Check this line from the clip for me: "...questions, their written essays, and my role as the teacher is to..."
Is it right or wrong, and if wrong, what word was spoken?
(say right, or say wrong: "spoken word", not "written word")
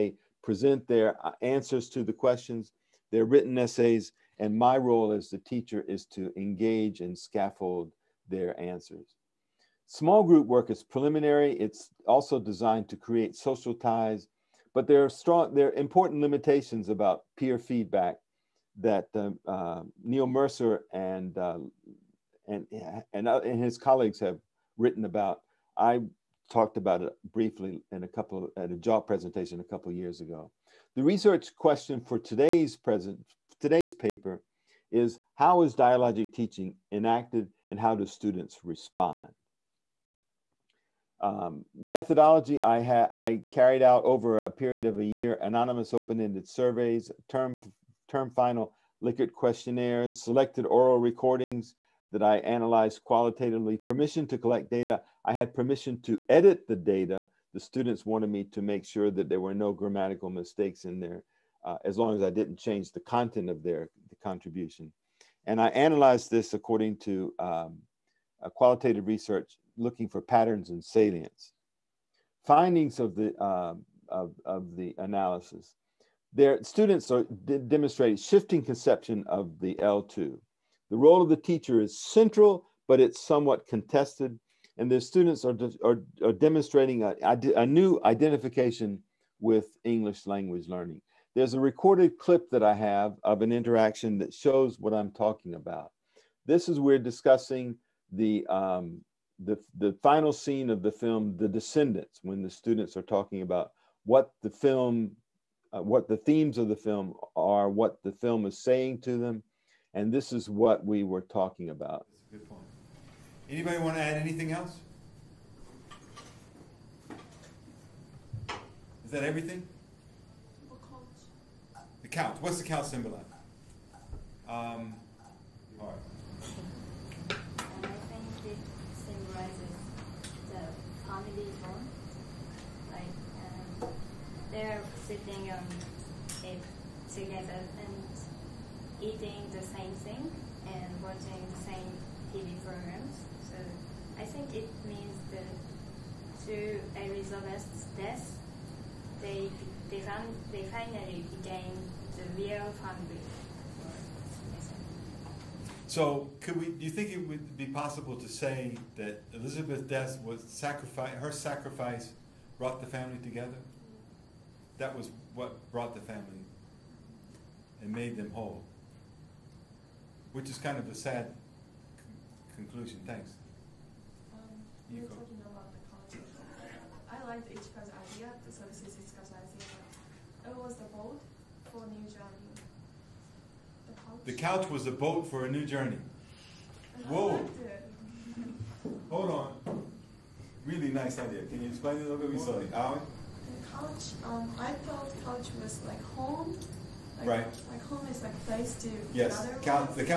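right.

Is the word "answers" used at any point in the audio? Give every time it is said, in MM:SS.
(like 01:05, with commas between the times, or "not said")
00:01, 00:08.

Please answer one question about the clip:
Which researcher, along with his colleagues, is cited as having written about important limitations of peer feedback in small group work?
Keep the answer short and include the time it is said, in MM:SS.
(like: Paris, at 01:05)
Neil Mercer, at 00:20.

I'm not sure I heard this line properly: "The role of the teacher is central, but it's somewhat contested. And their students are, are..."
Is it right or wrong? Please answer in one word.
right.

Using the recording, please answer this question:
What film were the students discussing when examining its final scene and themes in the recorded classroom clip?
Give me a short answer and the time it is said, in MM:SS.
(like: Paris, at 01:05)
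The Descendants, at 01:41.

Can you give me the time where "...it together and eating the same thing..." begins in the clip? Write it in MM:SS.
02:16.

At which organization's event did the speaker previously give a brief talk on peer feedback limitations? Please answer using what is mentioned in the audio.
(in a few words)
JALT.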